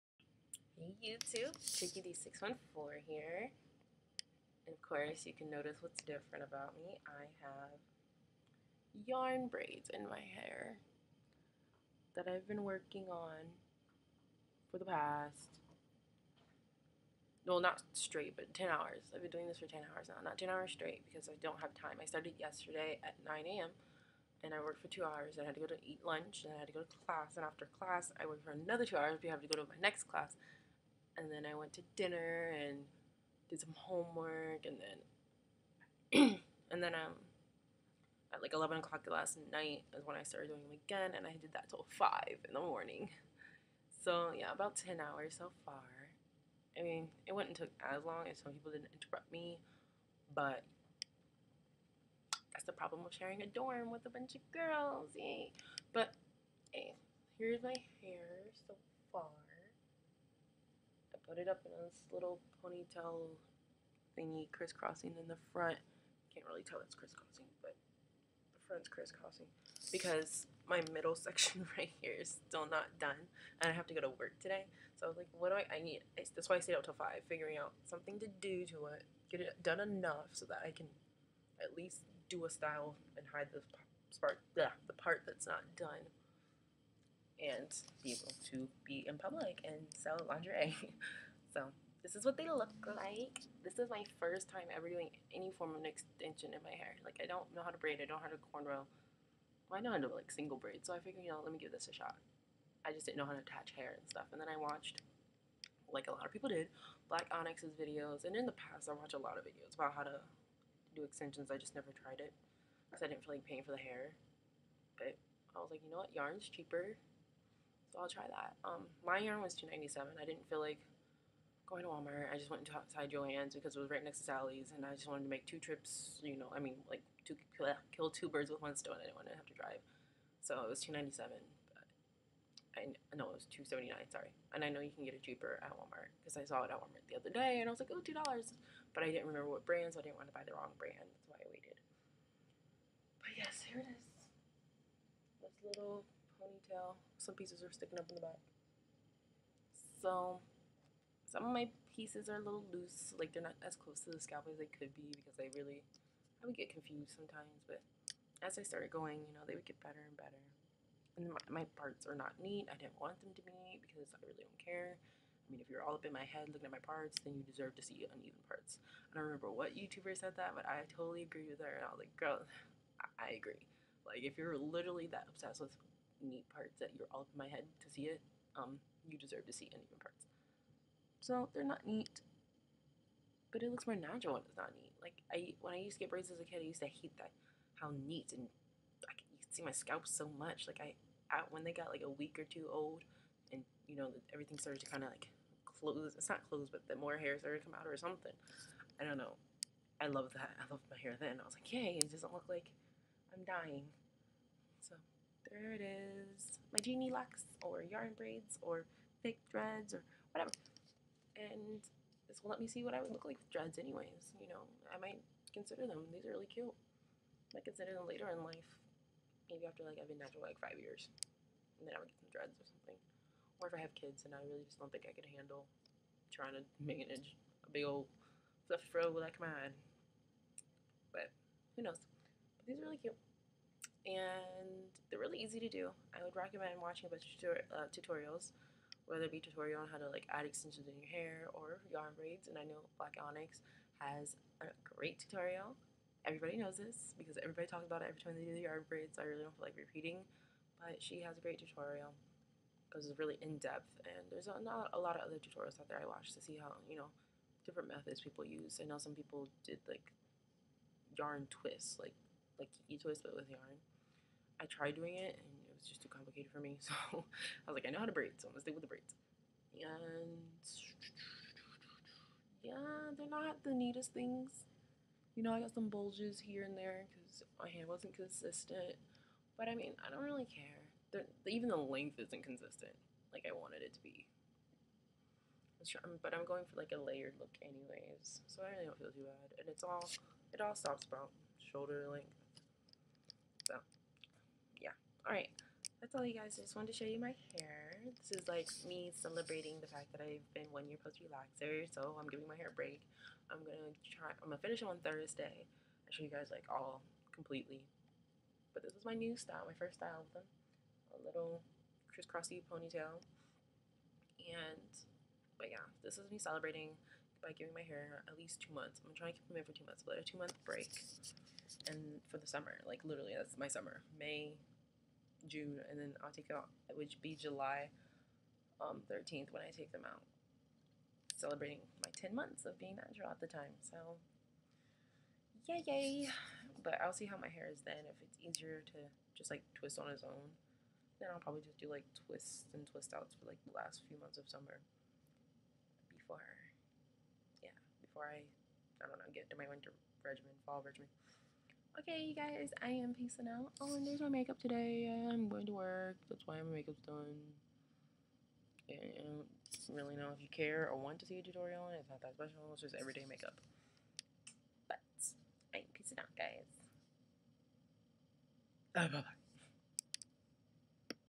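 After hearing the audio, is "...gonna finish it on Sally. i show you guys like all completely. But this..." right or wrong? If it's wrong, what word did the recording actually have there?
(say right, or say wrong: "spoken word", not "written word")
wrong: "Thursday", not "Sally".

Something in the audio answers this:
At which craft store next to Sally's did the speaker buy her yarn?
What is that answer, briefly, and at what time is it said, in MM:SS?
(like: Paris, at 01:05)
Jo-Ann's, at 02:03.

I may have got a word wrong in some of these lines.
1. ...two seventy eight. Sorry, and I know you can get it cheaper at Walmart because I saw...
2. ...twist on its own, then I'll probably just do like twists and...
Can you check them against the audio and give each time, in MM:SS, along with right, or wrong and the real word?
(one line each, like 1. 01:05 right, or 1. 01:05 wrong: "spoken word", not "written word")
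1. 02:13 wrong: "nine", not "eight"
2. 05:39 right.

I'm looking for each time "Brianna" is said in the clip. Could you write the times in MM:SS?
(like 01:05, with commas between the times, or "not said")
not said.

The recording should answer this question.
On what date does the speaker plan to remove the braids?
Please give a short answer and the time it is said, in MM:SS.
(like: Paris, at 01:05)
July 13th, at 05:27.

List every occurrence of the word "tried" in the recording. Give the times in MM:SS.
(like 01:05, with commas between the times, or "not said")
01:51, 04:24.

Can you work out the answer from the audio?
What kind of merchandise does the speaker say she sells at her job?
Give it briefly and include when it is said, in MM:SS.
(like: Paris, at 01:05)
lingerie, at 01:30.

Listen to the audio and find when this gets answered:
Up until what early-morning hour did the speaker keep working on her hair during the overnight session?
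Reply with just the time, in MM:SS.
00:41.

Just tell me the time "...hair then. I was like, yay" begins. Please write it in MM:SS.
03:21.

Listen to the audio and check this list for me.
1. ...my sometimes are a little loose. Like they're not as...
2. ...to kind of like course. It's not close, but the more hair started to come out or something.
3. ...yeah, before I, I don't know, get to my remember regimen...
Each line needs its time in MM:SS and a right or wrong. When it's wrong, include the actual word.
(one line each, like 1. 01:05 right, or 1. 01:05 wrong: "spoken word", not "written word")
1. 02:31 wrong: "pieces", not "sometimes"
2. 03:14 wrong: "close", not "course"
3. 05:47 wrong: "winter", not "remember".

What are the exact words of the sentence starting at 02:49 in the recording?
I don't remember what YouTuber said that, but I totally agree with her.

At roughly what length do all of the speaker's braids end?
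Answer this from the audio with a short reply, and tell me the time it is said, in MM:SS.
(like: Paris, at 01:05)
shoulder length, at 04:51.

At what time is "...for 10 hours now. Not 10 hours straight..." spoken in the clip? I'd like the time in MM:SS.
00:19.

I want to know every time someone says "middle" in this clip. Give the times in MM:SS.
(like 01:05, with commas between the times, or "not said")
01:10.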